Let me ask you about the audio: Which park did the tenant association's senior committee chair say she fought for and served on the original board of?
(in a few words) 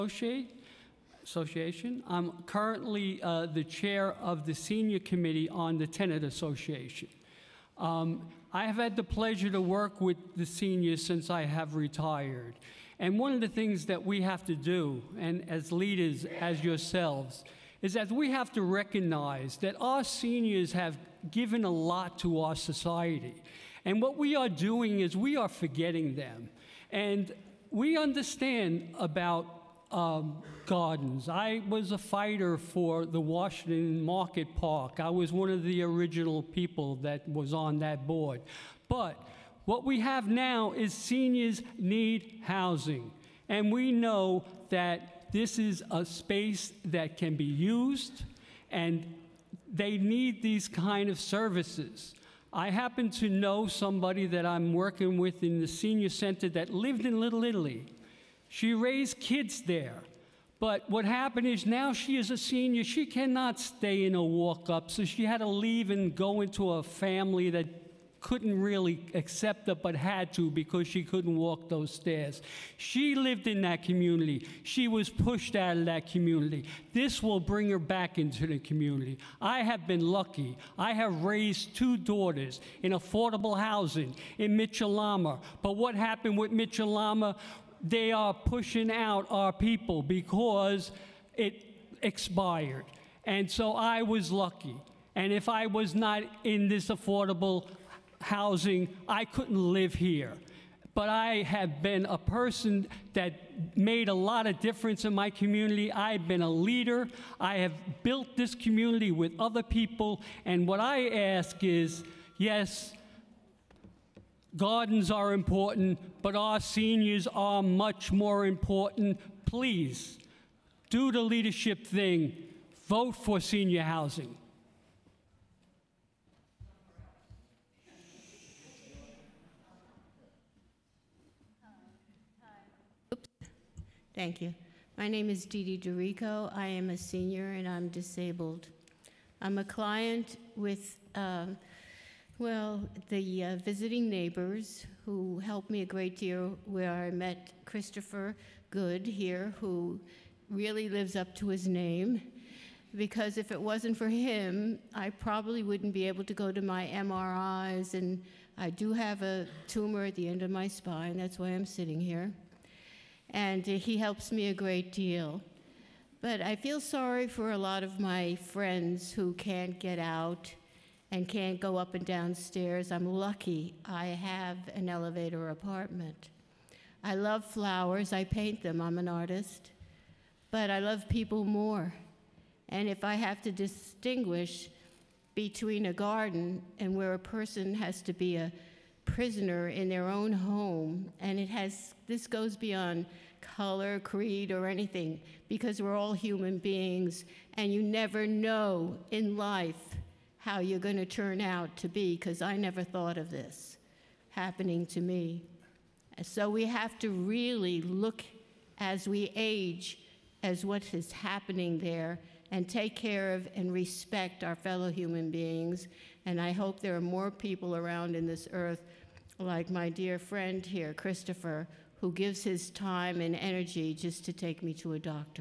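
Washington Market Park.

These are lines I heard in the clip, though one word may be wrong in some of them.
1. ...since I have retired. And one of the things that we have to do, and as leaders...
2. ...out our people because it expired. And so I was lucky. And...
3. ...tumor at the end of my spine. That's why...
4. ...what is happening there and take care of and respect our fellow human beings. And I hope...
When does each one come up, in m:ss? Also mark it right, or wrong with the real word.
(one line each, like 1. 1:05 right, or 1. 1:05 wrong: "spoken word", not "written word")
1. 0:11 right
2. 1:28 right
3. 2:39 right
4. 3:30 right.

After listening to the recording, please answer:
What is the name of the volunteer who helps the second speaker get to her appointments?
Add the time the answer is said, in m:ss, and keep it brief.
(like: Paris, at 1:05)
Christopher Good, at 2:27.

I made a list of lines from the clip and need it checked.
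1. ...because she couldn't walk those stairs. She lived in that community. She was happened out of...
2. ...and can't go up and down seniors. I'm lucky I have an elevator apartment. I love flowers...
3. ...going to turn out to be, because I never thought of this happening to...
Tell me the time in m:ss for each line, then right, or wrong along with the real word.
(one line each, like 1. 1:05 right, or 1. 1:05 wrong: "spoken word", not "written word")
1. 1:10 wrong: "pushed", not "happened"
2. 2:51 wrong: "stairs", not "seniors"
3. 3:20 right.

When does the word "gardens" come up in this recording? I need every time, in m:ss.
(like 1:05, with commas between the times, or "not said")
0:30, 1:54, 3:05.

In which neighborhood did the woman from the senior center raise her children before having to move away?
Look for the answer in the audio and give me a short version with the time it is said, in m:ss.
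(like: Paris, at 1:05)
Little Italy, at 0:57.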